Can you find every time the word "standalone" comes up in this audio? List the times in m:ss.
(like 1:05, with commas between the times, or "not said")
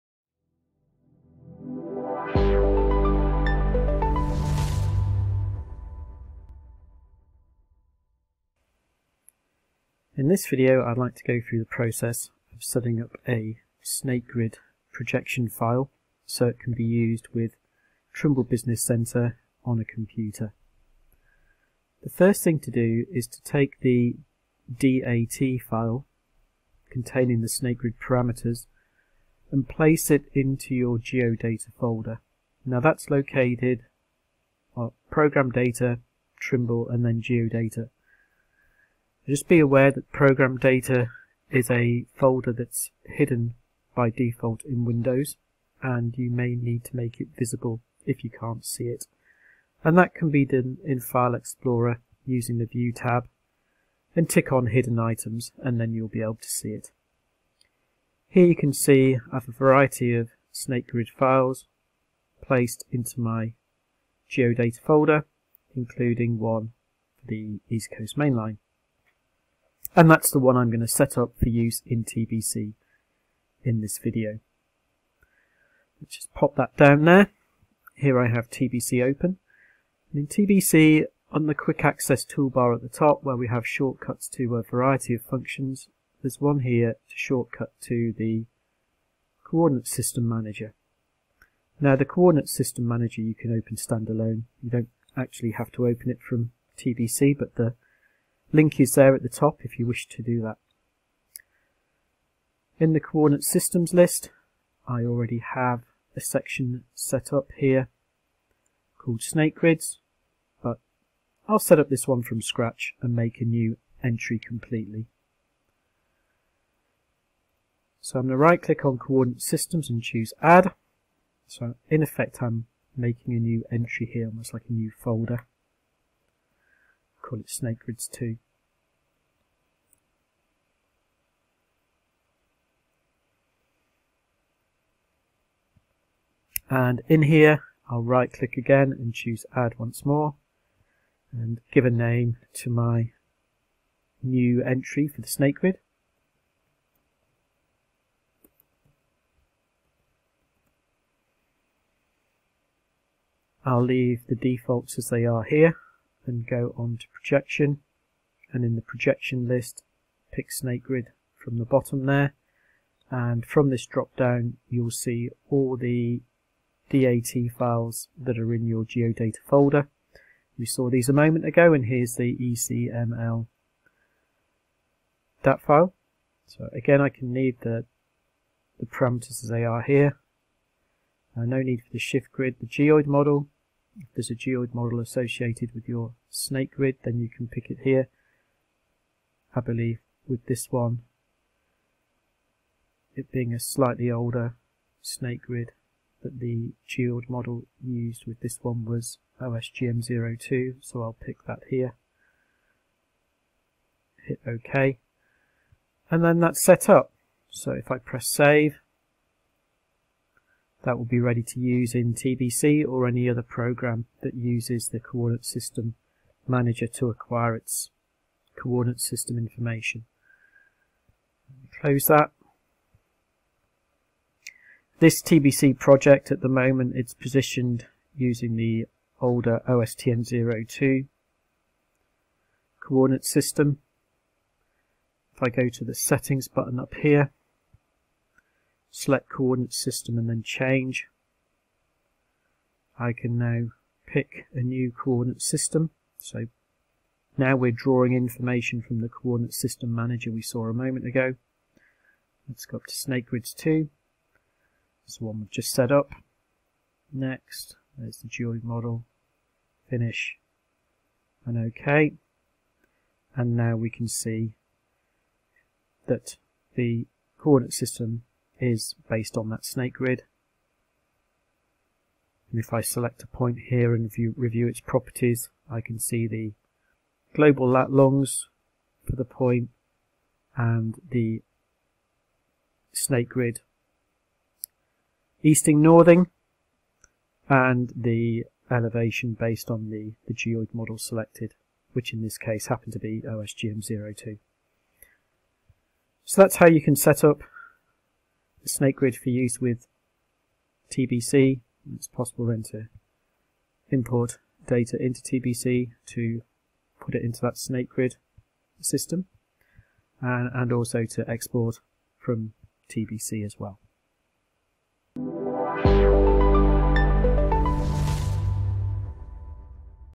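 1:33.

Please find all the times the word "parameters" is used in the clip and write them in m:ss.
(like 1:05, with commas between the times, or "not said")
0:27, 2:58.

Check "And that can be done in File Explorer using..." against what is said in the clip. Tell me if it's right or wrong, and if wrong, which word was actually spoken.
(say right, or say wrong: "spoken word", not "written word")
right.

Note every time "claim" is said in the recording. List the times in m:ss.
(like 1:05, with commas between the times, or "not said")
not said.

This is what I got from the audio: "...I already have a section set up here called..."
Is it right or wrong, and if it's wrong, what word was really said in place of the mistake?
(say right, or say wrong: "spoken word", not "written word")
right.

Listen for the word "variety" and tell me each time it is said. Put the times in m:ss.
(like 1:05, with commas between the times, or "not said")
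0:59, 1:24.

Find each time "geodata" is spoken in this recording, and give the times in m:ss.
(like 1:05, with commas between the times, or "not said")
0:30, 0:37, 1:04, 2:48.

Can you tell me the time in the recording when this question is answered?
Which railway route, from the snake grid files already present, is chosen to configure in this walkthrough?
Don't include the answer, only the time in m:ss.
1:07.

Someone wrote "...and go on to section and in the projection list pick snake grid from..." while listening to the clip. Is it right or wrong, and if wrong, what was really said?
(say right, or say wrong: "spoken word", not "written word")
wrong: "projection", not "section".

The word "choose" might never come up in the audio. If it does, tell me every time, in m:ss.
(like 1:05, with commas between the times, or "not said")
2:00, 2:19.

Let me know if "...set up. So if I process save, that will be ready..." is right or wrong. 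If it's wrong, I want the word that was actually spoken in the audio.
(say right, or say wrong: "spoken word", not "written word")
wrong: "press", not "process".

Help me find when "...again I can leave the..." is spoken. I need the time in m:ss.
2:56.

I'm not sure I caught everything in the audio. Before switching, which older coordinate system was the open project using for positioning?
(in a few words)
OSTN 2.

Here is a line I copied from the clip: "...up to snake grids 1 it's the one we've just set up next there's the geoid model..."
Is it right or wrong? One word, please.
wrong.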